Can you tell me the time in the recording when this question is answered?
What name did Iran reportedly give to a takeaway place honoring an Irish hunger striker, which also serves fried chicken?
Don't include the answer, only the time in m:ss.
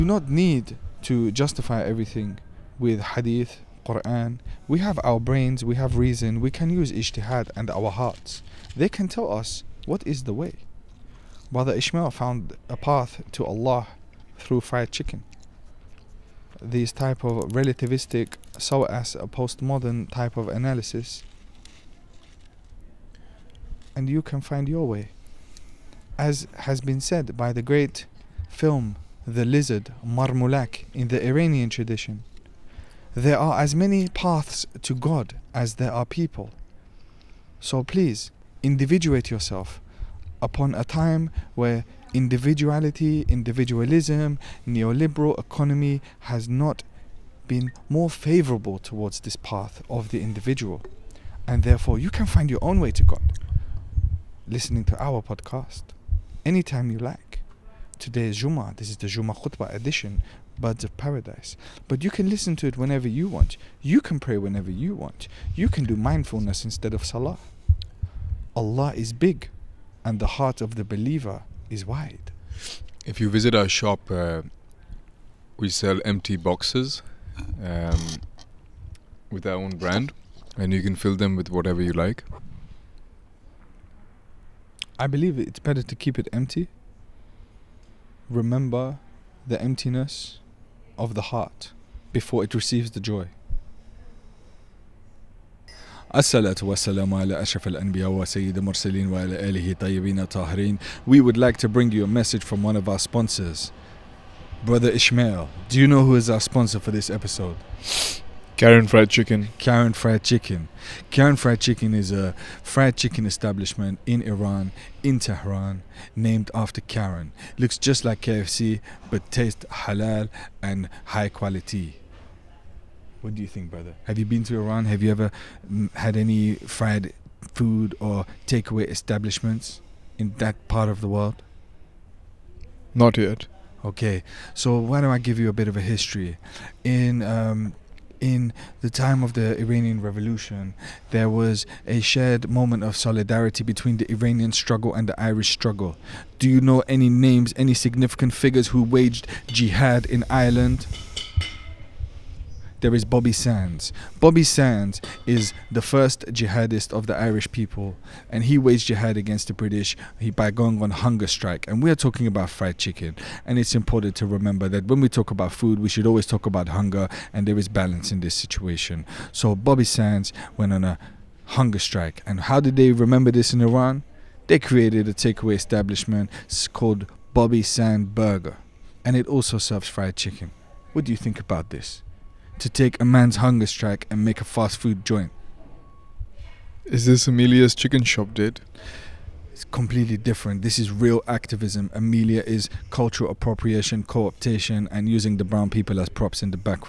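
2:57.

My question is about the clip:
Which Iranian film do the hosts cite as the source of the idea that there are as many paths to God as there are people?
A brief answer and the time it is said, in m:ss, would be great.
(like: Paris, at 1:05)
Marmulak, at 0:30.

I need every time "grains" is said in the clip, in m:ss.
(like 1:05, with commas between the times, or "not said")
not said.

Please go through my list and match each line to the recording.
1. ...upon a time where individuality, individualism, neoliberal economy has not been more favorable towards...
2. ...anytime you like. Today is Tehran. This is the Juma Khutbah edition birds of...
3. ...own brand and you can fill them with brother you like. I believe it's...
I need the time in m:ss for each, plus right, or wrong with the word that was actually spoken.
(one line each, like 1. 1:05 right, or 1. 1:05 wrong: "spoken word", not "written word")
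1. 0:40 right
2. 0:56 wrong: "Juma", not "Tehran"
3. 1:19 wrong: "whatever", not "brother".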